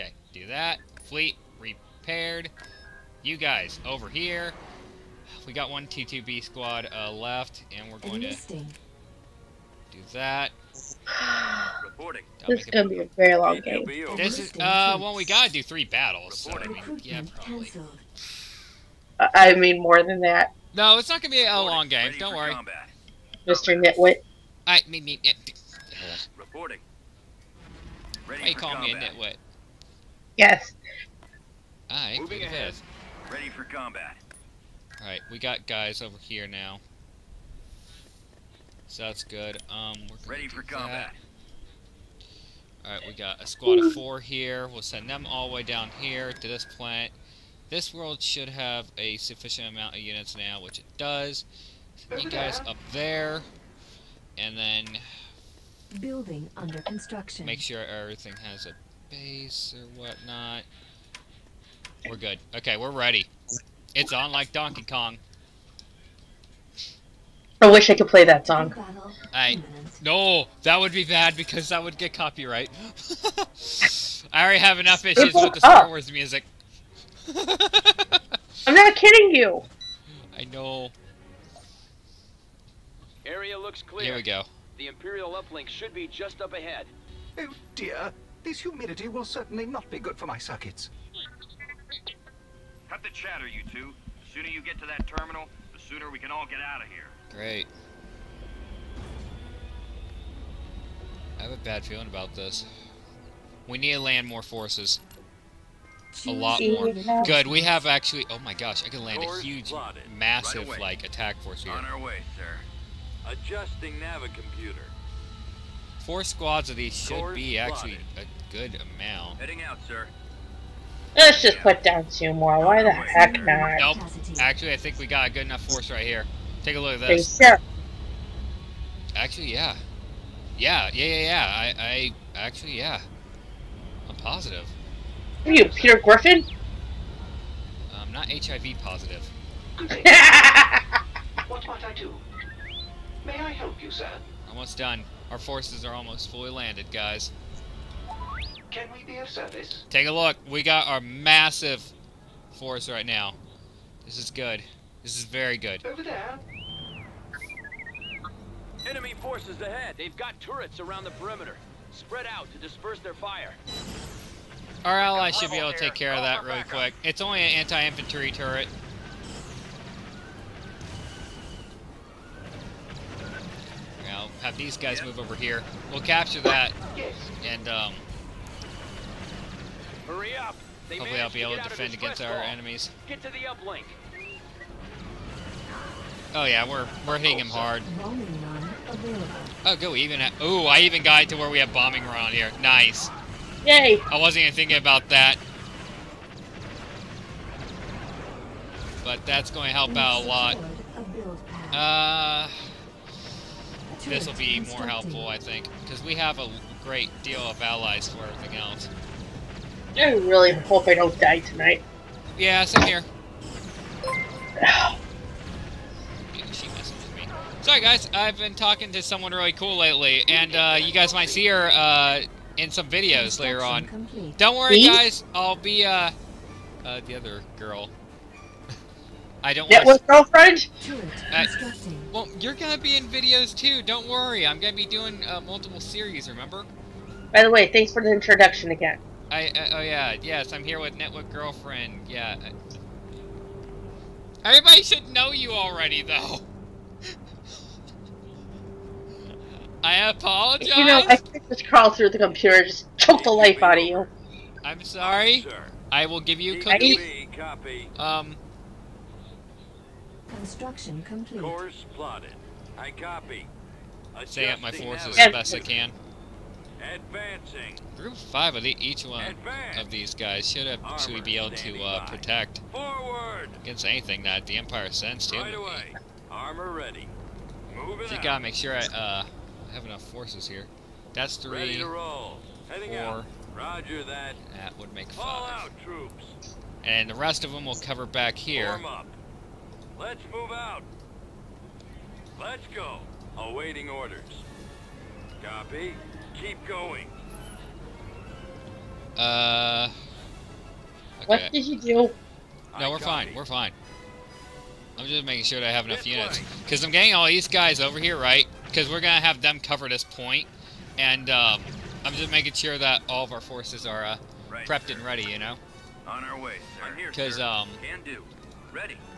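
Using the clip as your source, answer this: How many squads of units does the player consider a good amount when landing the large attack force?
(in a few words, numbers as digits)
4.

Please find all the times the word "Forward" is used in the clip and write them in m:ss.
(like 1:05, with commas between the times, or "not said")
4:32.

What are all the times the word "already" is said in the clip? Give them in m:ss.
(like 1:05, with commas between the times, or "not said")
1:14, 4:05.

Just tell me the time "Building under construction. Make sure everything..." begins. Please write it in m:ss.
0:56.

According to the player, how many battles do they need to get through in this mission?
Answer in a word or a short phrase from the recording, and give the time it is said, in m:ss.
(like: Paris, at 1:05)
3, at 0:15.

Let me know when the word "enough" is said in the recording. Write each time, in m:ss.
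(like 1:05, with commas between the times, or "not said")
1:14, 2:05, 4:39, 5:05.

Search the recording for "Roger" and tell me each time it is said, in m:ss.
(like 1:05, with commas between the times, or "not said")
4:43.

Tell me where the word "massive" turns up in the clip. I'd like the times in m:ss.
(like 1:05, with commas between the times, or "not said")
1:50, 2:30.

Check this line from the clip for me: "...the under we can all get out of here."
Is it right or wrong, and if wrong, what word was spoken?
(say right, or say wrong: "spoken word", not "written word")
wrong: "sooner", not "under".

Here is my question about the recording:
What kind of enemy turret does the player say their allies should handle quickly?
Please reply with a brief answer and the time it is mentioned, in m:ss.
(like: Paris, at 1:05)
Anti-infantry turret, at 2:47.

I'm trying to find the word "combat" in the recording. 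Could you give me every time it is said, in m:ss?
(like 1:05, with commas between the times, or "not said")
0:33, 0:40.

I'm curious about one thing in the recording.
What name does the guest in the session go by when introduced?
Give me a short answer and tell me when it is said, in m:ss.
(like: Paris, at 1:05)
Network Girlfriend, at 4:00.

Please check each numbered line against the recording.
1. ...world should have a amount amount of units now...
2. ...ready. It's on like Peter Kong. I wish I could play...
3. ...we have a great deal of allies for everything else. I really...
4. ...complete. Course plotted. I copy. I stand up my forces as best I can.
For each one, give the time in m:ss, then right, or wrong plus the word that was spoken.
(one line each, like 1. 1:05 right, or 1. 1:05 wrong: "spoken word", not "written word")
1. 0:47 wrong: "sufficient", not "amount"
2. 1:02 wrong: "Donkey", not "Peter"
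3. 3:26 right
4. 4:21 right.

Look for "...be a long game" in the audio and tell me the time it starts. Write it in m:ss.
0:21.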